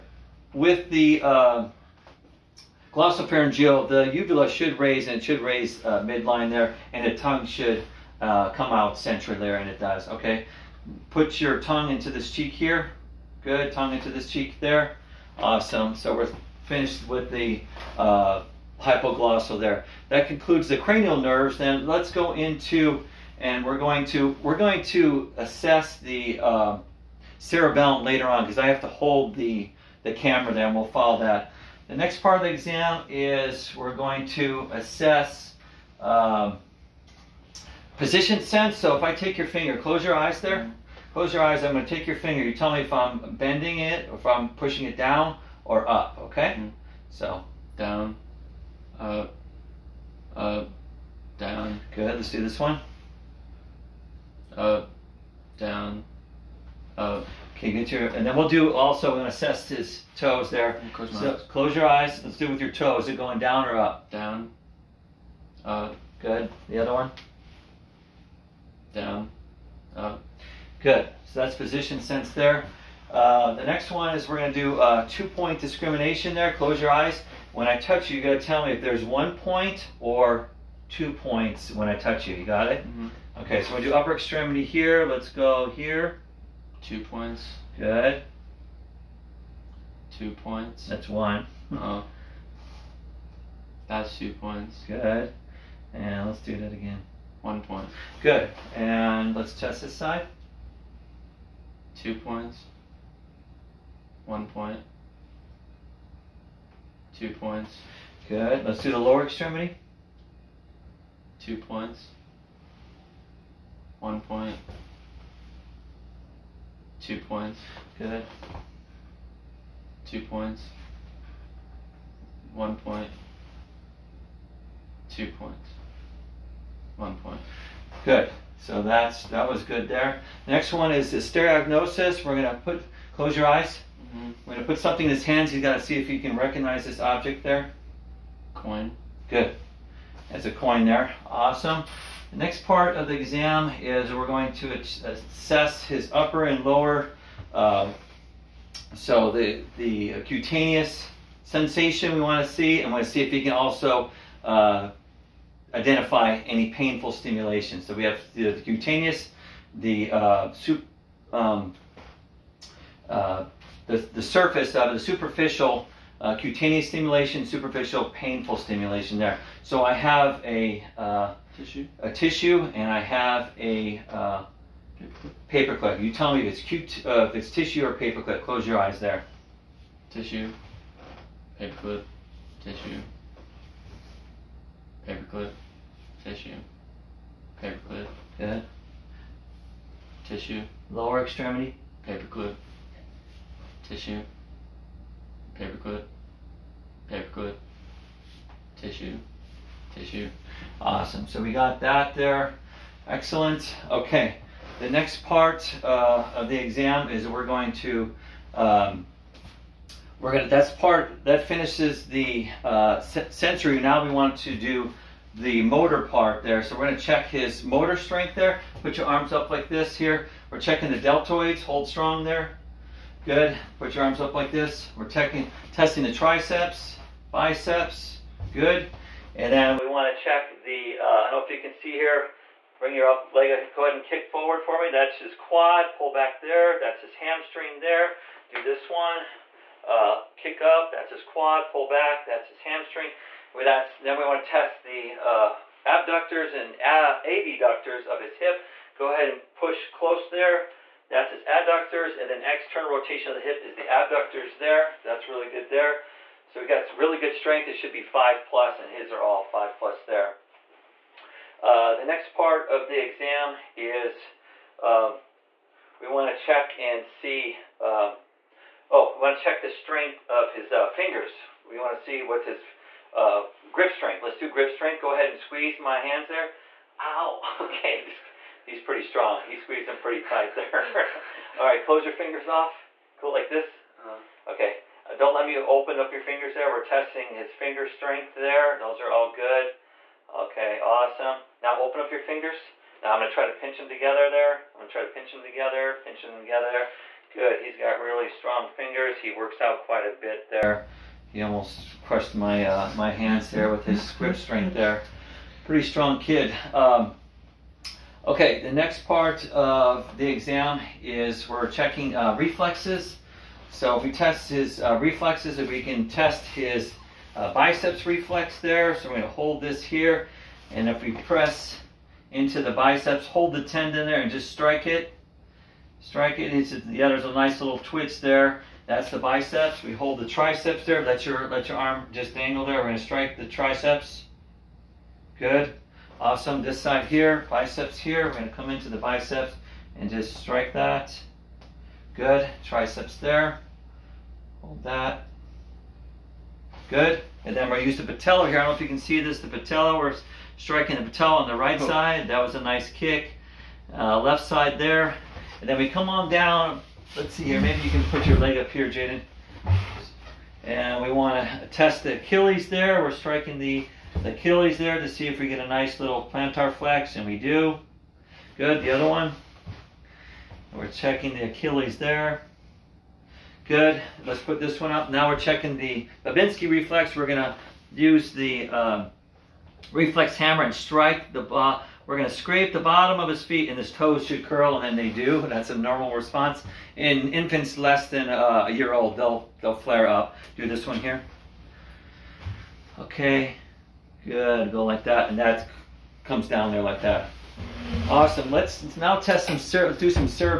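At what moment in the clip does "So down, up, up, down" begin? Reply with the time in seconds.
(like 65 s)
47 s.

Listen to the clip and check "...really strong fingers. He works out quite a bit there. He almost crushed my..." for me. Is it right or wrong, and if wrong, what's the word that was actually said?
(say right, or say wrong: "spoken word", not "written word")
right.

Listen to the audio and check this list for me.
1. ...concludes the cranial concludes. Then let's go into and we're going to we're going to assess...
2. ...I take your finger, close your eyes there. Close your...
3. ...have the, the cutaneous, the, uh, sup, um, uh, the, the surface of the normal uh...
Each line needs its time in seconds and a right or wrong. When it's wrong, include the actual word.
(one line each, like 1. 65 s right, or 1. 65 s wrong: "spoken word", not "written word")
1. 20 s wrong: "nerves", not "concludes"
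2. 39 s right
3. 158 s wrong: "superficial", not "normal".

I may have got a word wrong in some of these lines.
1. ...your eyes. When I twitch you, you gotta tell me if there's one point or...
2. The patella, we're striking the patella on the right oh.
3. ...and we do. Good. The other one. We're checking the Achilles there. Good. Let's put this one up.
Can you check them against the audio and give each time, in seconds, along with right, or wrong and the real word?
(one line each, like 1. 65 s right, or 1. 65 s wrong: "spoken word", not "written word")
1. 76 s wrong: "touch", not "twitch"
2. 349 s right
3. 367 s right.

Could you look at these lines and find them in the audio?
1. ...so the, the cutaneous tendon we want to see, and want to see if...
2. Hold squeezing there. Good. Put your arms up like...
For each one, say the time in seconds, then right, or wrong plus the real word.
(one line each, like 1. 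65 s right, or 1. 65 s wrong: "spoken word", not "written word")
1. 148 s wrong: "sensation", not "tendon"
2. 221 s wrong: "strong", not "squeezing".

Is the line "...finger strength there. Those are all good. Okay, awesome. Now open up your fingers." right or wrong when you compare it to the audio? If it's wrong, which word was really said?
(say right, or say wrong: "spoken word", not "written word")
right.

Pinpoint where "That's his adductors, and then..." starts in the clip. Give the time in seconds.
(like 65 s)
251 s.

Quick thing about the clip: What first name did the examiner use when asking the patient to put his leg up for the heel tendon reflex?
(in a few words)
Jaden.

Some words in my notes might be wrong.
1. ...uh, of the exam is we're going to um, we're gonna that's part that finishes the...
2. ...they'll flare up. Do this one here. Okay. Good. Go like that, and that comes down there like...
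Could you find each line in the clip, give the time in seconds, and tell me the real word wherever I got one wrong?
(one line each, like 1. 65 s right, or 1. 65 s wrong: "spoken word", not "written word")
1. 205 s right
2. 389 s right.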